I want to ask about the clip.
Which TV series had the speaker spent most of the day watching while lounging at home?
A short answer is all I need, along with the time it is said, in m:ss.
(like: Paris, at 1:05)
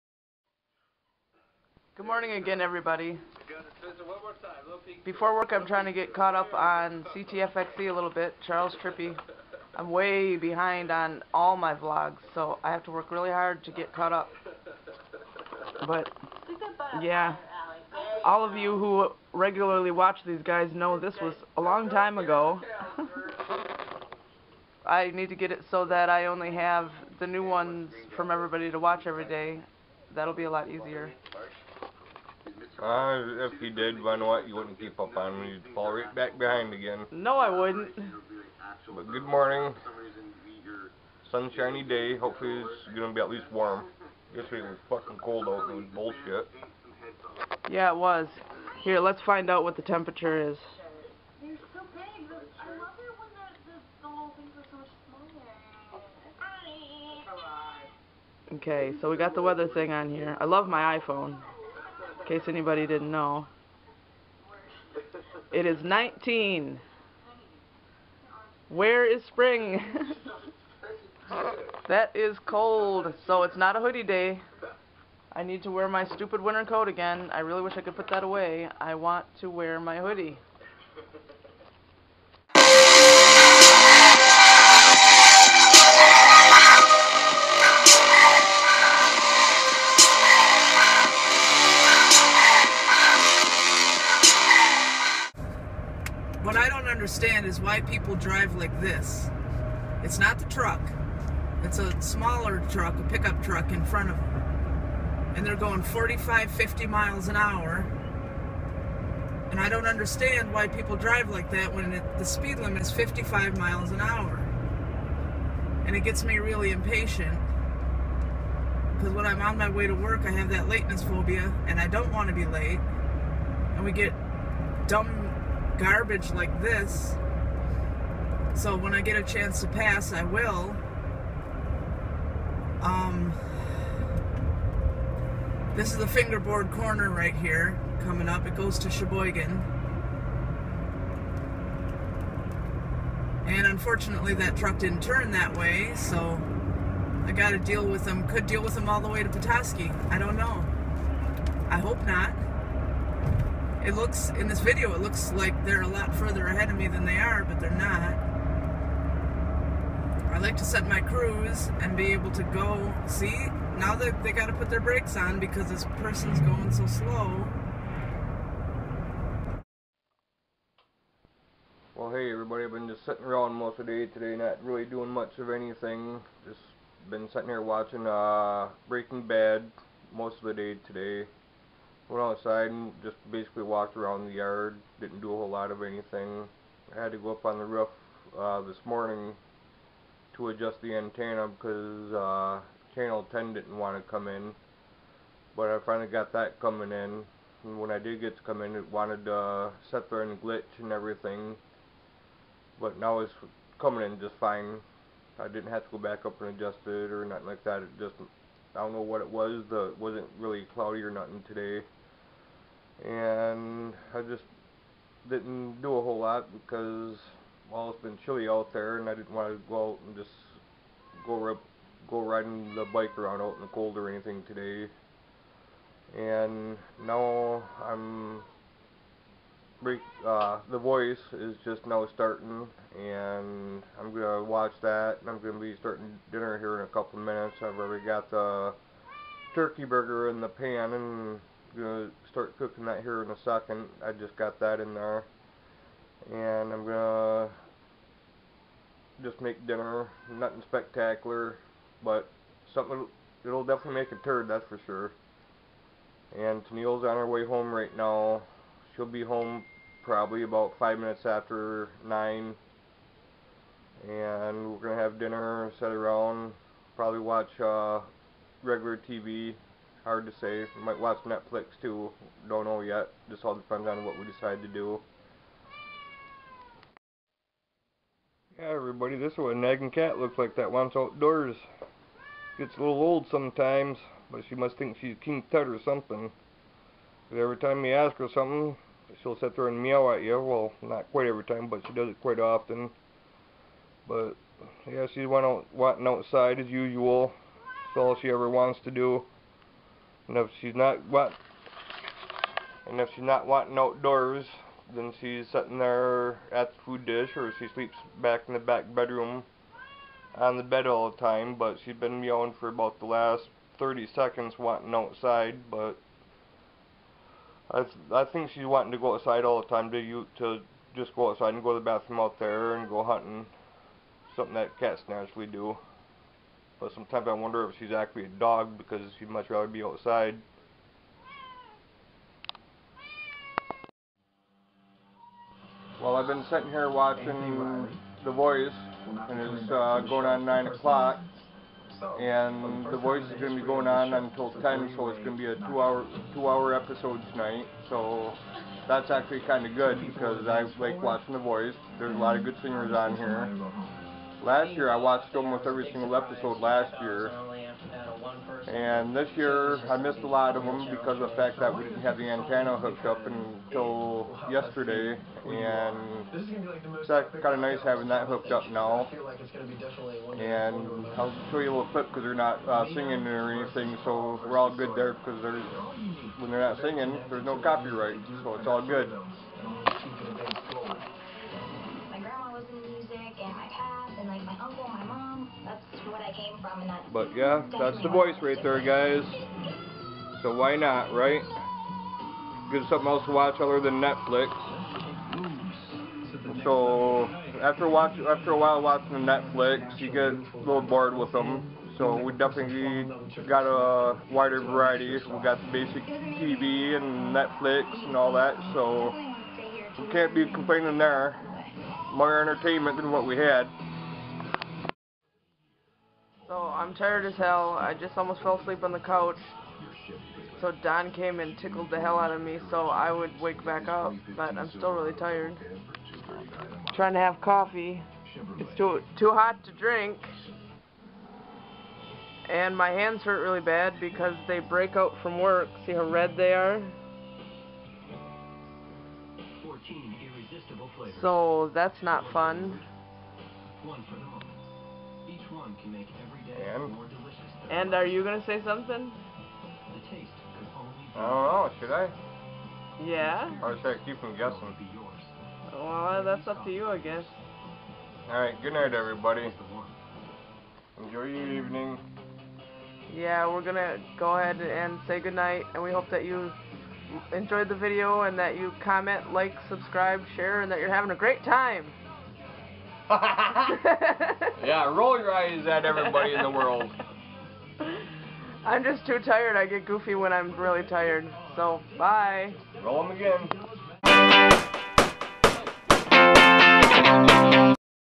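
Breaking Bad, at 2:58.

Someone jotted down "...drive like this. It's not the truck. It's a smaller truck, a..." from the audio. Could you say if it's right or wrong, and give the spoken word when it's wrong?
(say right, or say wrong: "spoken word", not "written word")
right.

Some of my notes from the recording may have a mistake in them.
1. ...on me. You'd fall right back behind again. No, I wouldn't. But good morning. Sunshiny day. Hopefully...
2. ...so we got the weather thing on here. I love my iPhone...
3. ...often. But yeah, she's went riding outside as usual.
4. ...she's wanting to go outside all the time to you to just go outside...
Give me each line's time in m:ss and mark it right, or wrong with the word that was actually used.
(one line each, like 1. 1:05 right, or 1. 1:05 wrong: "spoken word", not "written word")
1. 0:35 right
2. 0:58 right
3. 4:52 wrong: "wanting", not "riding"
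4. 5:18 right.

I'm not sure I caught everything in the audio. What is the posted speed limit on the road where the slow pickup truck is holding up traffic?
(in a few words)
55 miles an hour.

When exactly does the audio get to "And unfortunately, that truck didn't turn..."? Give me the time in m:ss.
2:23.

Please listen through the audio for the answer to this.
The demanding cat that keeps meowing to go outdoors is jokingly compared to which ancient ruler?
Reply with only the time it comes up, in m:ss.
4:45.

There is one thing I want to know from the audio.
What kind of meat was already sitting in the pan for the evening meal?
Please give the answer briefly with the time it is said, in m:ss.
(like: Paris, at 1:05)
turkey burger, at 3:59.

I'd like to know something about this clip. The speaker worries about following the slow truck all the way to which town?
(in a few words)
Petoskey.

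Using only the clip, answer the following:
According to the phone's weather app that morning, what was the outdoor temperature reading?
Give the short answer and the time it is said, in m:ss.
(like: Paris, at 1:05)
19, at 1:05.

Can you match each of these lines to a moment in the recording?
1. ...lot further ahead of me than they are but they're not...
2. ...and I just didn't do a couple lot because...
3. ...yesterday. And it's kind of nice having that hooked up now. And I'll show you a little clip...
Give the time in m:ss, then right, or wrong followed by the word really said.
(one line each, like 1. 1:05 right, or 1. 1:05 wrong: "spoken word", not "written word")
1. 2:35 right
2. 3:33 wrong: "whole", not "couple"
3. 6:04 right.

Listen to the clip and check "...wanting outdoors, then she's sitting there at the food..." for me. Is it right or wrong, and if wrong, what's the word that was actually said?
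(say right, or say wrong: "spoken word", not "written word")
right.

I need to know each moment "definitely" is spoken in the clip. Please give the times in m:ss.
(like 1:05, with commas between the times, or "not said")
4:13, 6:42.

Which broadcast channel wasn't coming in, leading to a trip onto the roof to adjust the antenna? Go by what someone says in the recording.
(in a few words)
channel 10.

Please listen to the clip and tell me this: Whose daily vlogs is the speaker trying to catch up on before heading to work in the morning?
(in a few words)
Charles Trippy.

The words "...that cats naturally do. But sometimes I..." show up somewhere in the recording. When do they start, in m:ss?
5:24.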